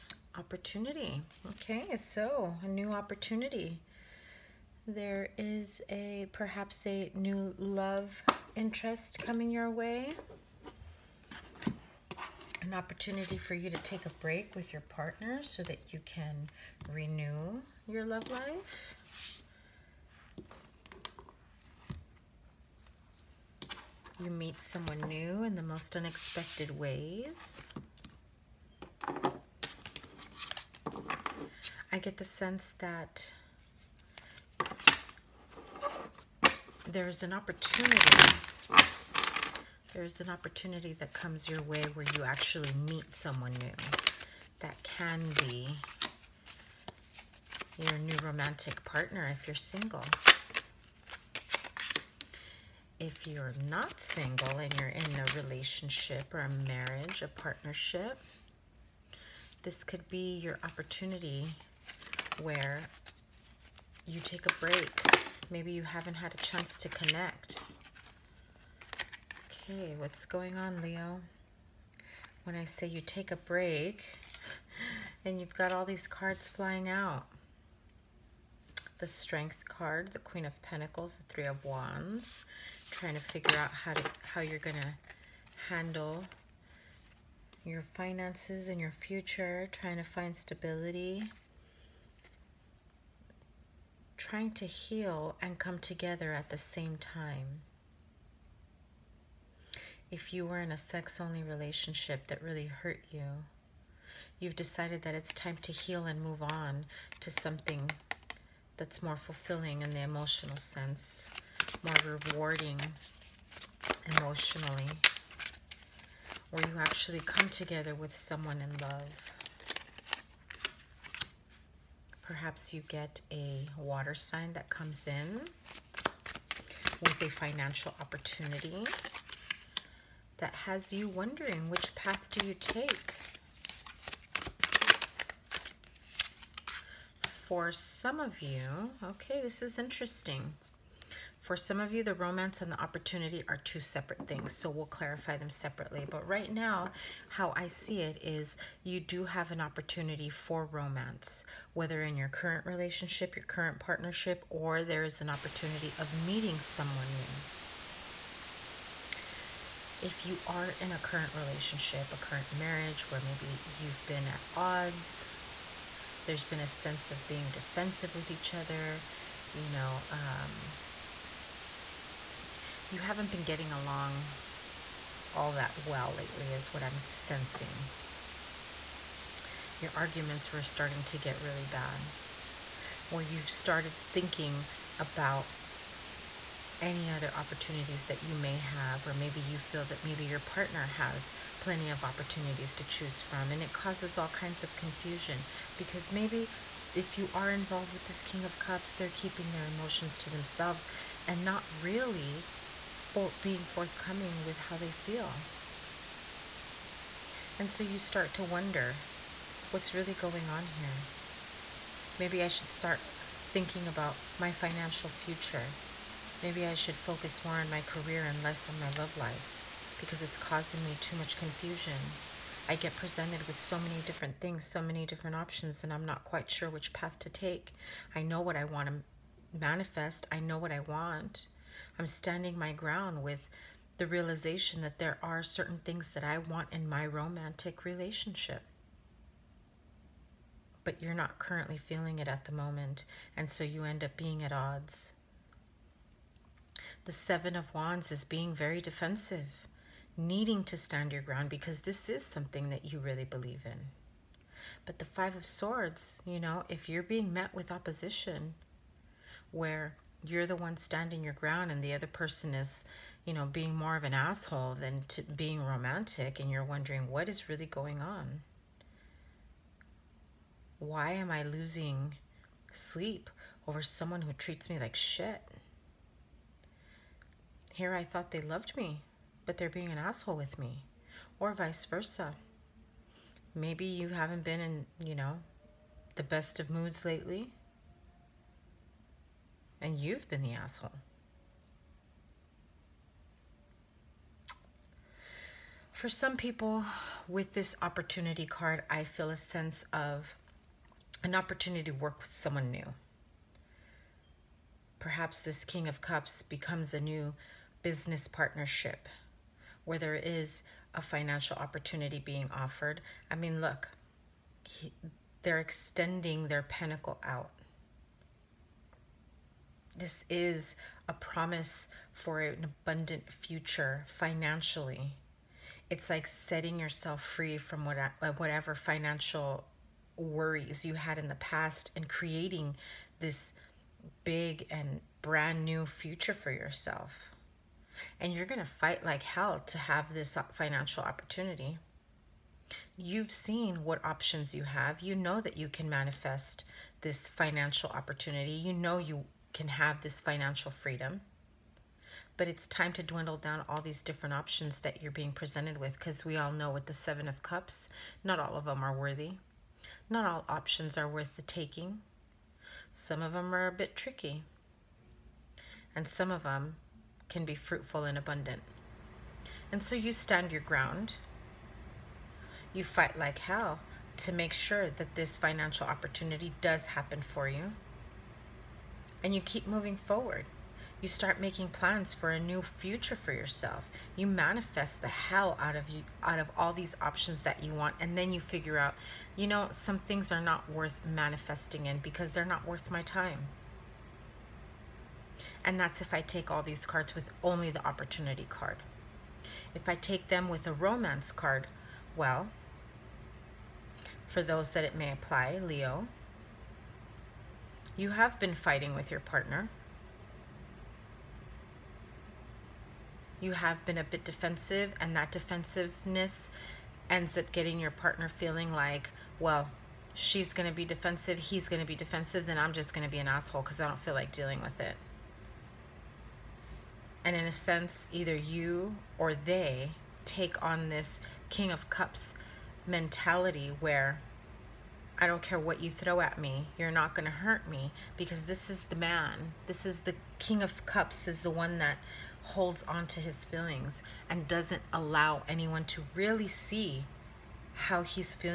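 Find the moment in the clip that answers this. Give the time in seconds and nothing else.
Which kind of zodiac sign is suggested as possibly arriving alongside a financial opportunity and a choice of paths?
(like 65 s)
123 s.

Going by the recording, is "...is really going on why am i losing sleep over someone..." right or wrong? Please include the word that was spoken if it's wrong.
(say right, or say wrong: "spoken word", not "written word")
right.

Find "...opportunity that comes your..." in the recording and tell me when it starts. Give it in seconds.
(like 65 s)
40 s.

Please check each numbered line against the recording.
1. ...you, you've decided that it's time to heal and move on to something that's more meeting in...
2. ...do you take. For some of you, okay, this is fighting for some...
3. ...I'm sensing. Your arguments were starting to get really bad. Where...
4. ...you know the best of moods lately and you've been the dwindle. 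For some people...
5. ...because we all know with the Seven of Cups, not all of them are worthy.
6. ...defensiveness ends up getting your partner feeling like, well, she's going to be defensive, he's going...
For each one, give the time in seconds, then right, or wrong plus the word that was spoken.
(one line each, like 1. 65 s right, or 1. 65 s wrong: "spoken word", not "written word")
1. 103 s wrong: "fulfilling", not "meeting"
2. 132 s wrong: "interesting", not "fighting"
3. 176 s right
4. 285 s wrong: "asshole", not "dwindle"
5. 355 s right
6. 415 s right.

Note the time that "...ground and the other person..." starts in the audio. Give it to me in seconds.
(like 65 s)
261 s.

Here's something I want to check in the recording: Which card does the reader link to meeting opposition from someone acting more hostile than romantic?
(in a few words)
Five of Swords.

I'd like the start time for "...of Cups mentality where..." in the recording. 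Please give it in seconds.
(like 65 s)
431 s.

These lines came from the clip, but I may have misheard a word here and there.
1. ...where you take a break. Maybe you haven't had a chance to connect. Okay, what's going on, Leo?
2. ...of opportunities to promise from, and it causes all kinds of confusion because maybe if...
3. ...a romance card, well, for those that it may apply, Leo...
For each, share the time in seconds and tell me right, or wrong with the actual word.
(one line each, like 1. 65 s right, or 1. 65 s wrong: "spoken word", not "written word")
1. 62 s right
2. 191 s wrong: "choose", not "promise"
3. 400 s right.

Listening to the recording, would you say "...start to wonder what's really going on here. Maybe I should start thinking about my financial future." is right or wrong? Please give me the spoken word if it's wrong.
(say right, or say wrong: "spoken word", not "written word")
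right.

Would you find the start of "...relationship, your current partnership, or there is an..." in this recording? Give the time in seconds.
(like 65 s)
152 s.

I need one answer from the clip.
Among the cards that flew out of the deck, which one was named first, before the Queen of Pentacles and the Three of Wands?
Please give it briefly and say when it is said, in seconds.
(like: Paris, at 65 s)
The Strength card, at 78 s.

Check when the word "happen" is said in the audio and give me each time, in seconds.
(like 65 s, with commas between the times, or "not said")
376 s.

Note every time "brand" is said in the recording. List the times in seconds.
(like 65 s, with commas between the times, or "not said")
335 s.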